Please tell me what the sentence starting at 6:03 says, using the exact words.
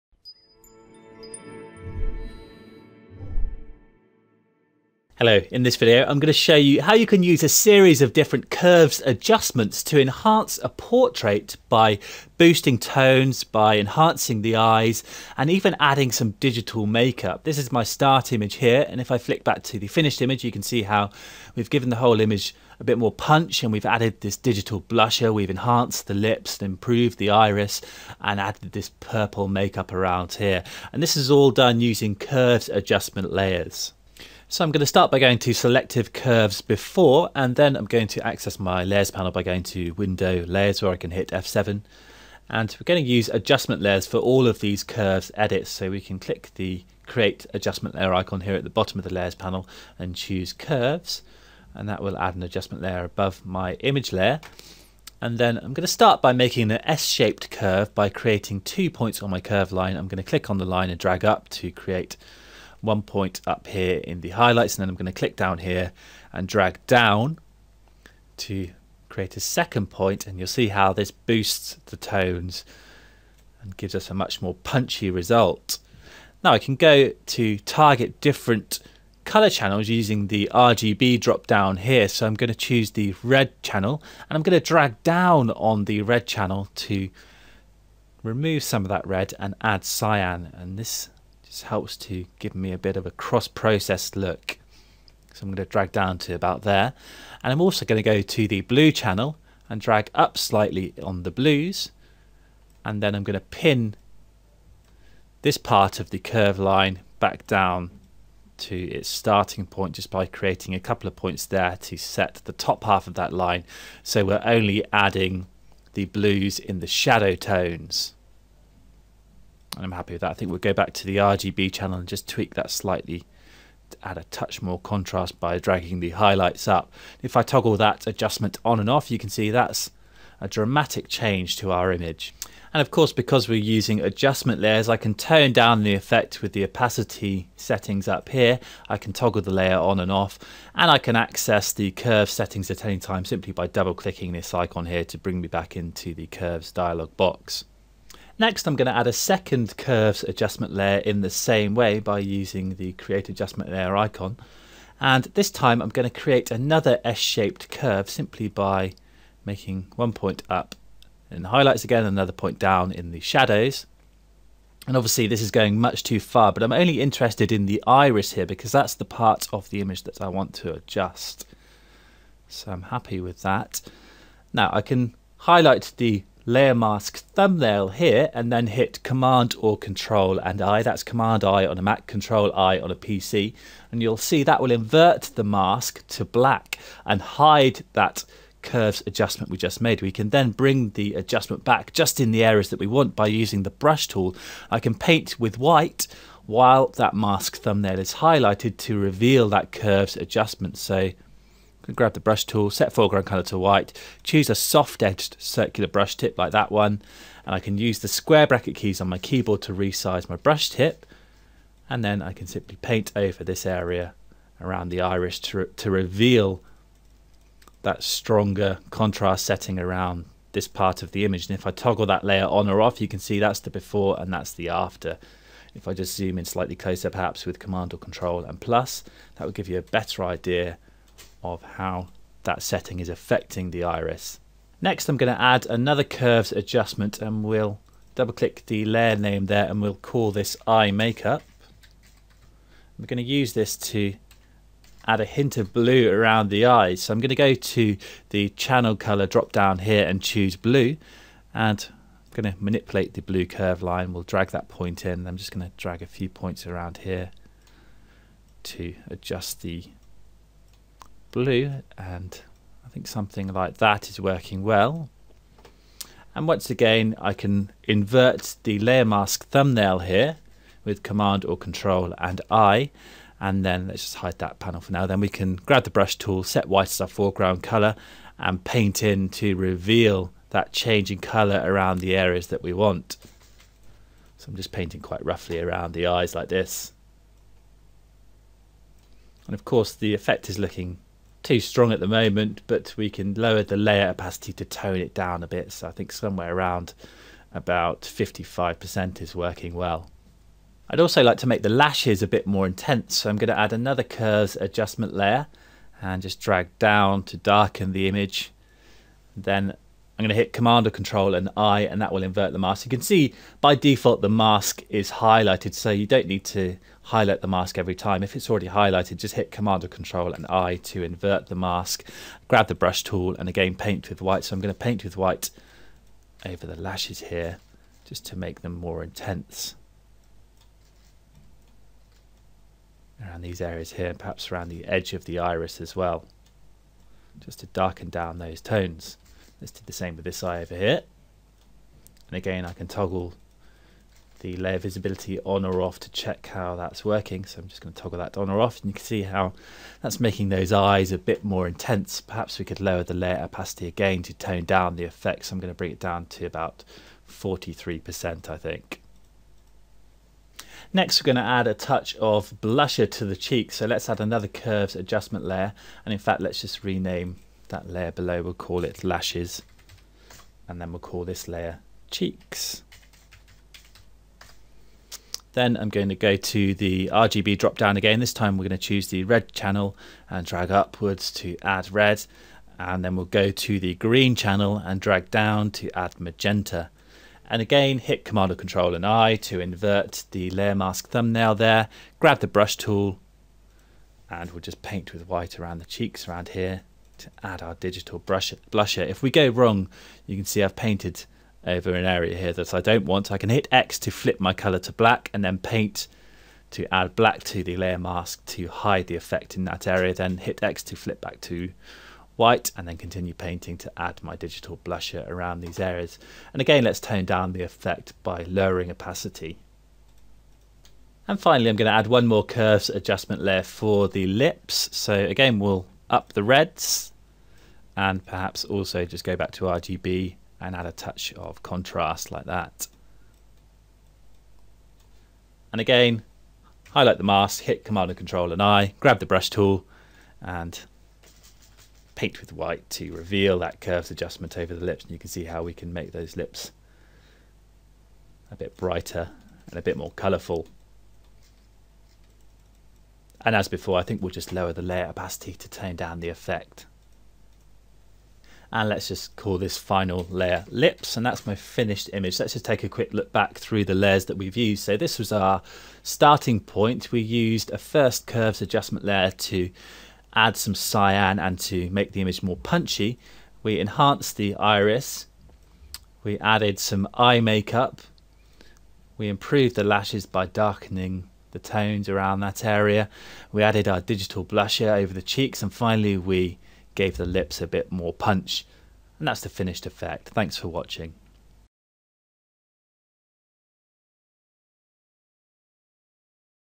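So let's add another curves adjustment layer.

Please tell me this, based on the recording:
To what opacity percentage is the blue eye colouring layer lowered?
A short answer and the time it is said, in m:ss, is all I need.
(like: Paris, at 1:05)
55%, at 4:58.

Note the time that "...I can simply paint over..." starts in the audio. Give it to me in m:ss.
3:32.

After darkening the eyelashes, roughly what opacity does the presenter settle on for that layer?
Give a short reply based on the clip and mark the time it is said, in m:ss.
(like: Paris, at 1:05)
43%, at 5:57.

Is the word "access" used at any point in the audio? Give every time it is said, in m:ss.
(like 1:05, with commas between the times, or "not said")
0:38, 2:21.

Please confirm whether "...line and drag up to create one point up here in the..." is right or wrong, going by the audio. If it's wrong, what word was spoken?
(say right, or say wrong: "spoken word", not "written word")
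right.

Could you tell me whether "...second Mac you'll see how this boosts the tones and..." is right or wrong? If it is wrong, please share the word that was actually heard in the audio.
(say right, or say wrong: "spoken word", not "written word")
wrong: "And", not "Mac".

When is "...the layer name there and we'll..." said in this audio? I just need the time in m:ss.
3:58.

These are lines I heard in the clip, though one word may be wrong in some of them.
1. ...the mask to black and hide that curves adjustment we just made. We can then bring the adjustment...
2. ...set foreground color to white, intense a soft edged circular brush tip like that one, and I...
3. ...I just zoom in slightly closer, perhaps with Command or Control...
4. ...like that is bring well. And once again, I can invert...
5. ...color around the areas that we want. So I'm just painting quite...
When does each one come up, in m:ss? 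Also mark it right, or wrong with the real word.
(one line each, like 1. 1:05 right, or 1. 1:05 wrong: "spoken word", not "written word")
1. 3:05 right
2. 3:22 wrong: "choose", not "intense"
3. 3:45 right
4. 4:23 wrong: "working", not "bring"
5. 4:41 right.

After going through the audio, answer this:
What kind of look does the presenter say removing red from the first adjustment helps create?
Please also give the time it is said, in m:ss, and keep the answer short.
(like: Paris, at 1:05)
Cross-processed look, at 1:33.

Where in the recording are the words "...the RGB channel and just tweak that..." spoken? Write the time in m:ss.
2:01.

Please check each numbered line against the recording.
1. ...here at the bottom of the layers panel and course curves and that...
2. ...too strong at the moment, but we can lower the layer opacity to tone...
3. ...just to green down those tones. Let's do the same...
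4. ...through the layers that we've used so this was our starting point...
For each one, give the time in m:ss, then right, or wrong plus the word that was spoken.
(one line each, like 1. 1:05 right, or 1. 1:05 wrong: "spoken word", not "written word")
1. 0:48 wrong: "choose", not "course"
2. 4:51 right
3. 5:37 wrong: "darken", not "green"
4. 7:43 right.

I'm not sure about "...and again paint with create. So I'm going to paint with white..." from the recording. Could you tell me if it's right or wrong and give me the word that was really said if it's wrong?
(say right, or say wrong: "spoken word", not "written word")
wrong: "white", not "create".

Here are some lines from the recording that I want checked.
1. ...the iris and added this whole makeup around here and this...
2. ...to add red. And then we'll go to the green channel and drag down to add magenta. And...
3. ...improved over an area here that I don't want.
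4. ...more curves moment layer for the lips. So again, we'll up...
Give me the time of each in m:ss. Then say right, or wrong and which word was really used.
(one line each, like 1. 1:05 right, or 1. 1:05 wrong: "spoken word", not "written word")
1. 0:27 wrong: "purple", not "whole"
2. 6:21 right
3. 6:40 wrong: "painted", not "improved"
4. 7:02 wrong: "adjustment", not "moment".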